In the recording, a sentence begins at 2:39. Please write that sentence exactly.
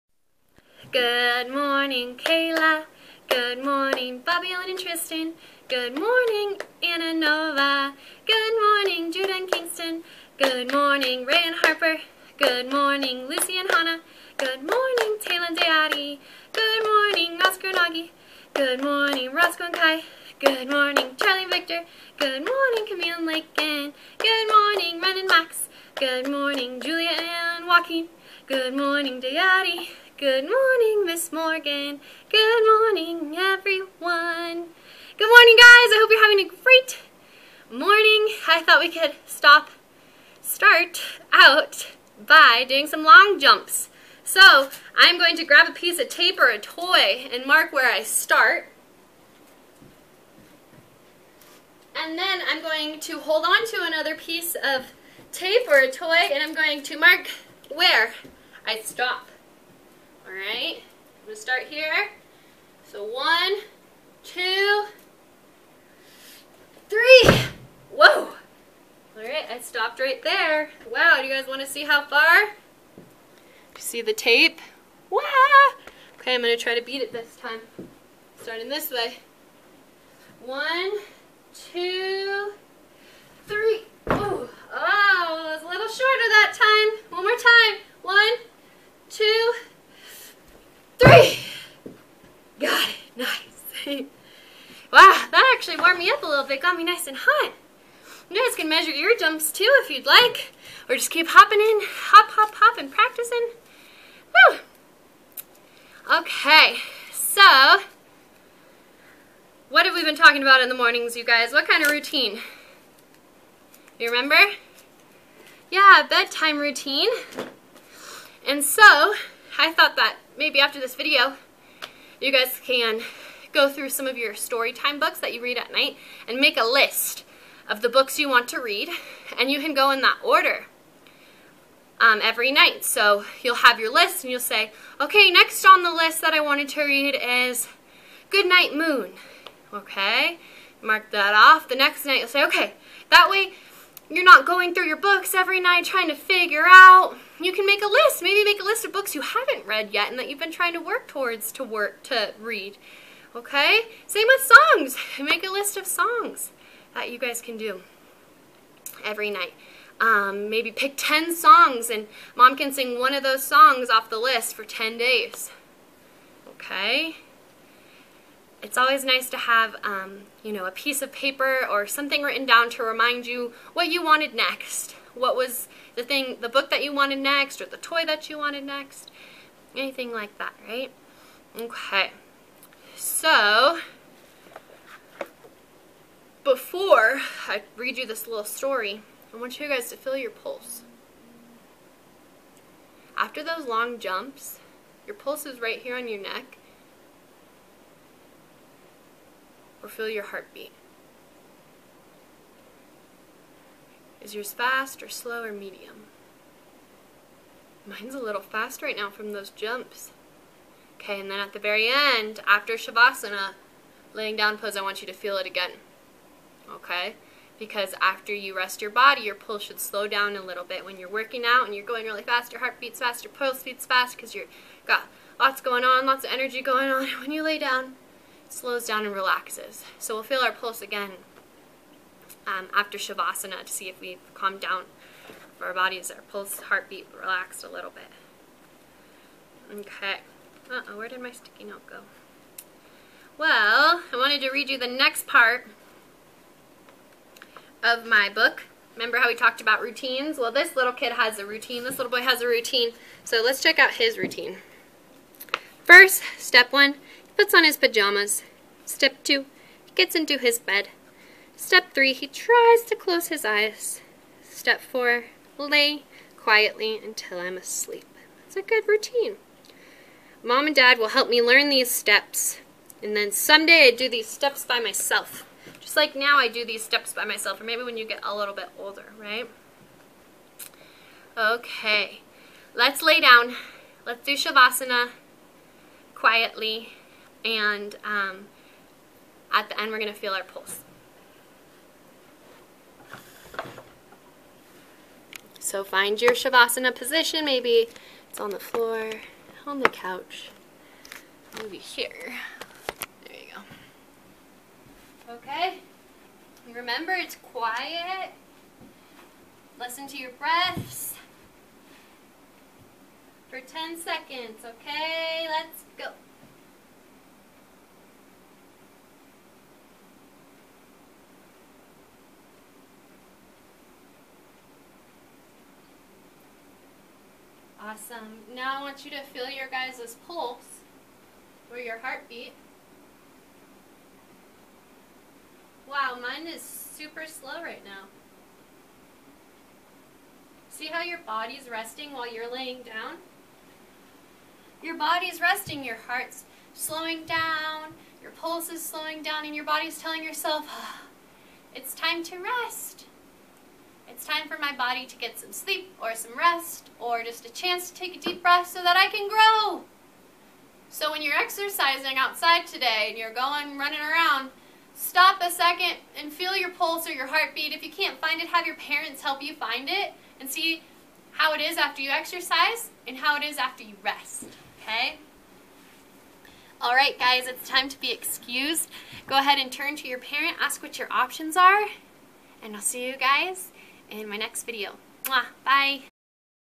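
Um, maybe pick 10 songs and mom can sing one of those songs off the list for 10 days.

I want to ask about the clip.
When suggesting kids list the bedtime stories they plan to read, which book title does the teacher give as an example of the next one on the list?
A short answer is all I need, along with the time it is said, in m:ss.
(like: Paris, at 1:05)
Good Night Moon, at 2:18.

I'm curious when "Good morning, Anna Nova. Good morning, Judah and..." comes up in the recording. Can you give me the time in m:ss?
0:05.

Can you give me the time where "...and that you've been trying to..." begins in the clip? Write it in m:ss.
2:30.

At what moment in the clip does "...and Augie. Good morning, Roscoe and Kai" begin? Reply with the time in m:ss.
0:17.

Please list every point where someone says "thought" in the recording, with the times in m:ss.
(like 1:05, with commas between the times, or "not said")
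0:38, 1:59.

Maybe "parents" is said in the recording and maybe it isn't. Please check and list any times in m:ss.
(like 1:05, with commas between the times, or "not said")
6:08, 6:20.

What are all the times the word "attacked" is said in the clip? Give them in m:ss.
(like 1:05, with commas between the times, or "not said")
not said.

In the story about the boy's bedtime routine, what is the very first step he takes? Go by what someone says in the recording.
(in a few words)
puts on his pajamas.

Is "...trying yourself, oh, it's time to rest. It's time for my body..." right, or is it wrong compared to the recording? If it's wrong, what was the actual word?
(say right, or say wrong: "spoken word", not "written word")
wrong: "telling", not "trying".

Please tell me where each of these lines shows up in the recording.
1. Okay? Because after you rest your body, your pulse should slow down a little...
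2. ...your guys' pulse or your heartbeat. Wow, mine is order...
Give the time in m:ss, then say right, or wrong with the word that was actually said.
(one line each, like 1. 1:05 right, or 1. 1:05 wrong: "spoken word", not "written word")
1. 3:36 right
2. 5:29 wrong: "super", not "order".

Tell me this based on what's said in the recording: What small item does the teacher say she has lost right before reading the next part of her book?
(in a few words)
sticky note.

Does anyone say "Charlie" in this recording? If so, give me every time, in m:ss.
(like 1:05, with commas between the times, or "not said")
0:21.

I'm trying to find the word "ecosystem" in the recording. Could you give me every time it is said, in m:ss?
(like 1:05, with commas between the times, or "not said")
not said.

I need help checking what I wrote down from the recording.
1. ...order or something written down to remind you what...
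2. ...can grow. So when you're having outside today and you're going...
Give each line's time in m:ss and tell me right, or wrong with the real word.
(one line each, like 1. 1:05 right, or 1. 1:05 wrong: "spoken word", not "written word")
1. 2:51 wrong: "paper", not "order"
2. 5:59 wrong: "exercising", not "having".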